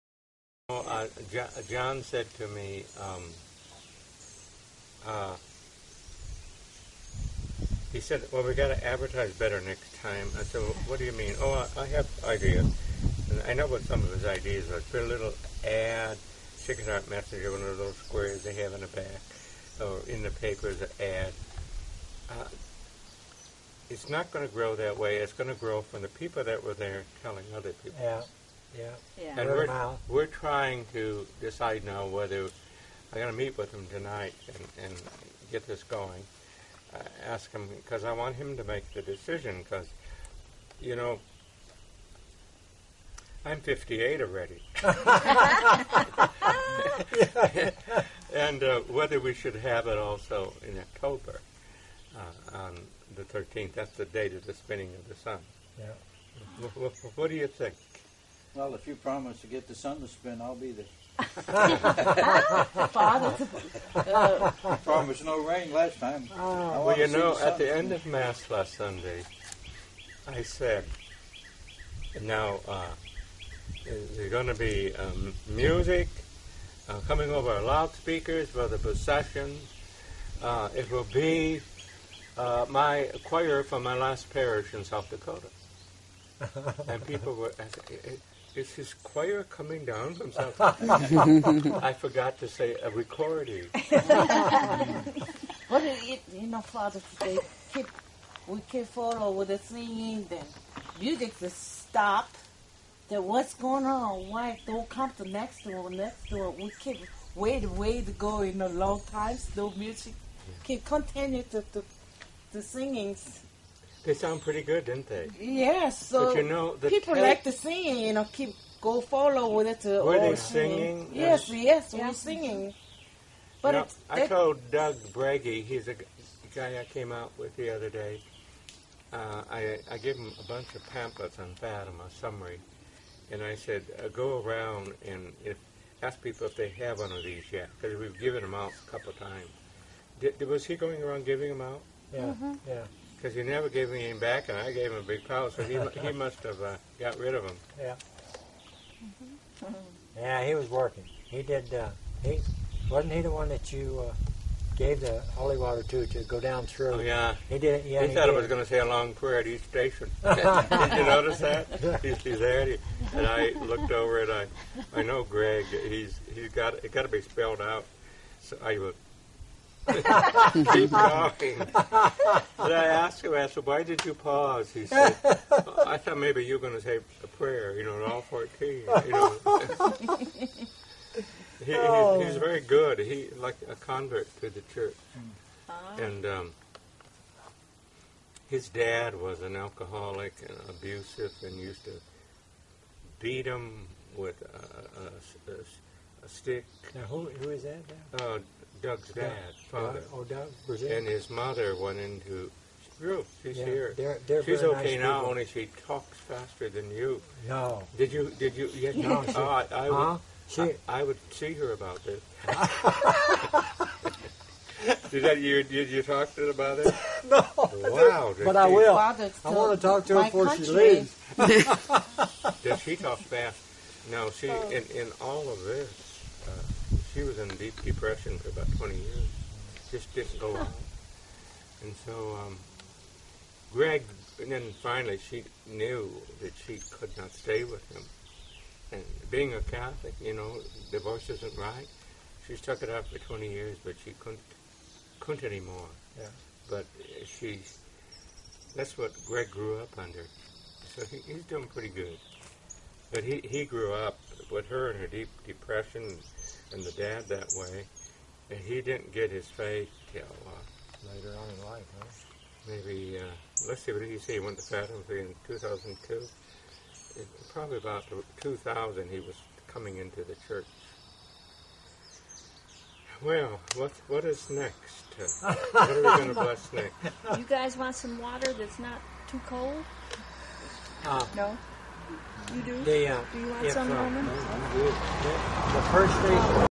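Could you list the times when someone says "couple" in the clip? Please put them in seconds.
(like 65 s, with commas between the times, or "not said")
138 s.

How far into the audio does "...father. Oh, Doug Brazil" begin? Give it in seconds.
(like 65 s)
199 s.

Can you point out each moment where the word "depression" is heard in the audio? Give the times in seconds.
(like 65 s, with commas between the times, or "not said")
227 s, 255 s.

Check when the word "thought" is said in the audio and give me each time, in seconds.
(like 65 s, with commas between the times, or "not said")
158 s, 175 s.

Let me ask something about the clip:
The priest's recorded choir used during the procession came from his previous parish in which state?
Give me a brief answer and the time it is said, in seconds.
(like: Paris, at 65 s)
South Dakota, at 84 s.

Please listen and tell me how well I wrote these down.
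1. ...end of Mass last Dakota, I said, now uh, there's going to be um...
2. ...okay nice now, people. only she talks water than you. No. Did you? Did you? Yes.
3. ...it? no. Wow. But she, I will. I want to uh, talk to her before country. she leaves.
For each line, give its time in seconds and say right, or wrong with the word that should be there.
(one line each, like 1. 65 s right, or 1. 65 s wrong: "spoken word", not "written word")
1. 67 s wrong: "Sunday", not "Dakota"
2. 204 s wrong: "faster", not "water"
3. 216 s right.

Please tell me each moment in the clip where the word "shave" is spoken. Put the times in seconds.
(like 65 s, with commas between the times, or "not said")
not said.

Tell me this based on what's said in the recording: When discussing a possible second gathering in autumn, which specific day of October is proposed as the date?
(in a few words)
13th.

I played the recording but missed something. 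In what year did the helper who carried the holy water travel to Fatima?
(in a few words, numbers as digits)
2002.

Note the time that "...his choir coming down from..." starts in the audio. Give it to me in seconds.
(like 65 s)
88 s.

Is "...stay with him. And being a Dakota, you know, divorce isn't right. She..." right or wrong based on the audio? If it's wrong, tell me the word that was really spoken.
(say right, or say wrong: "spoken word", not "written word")
wrong: "Catholic", not "Dakota".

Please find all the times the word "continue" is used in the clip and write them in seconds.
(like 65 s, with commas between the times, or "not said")
110 s.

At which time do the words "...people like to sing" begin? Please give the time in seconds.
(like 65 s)
116 s.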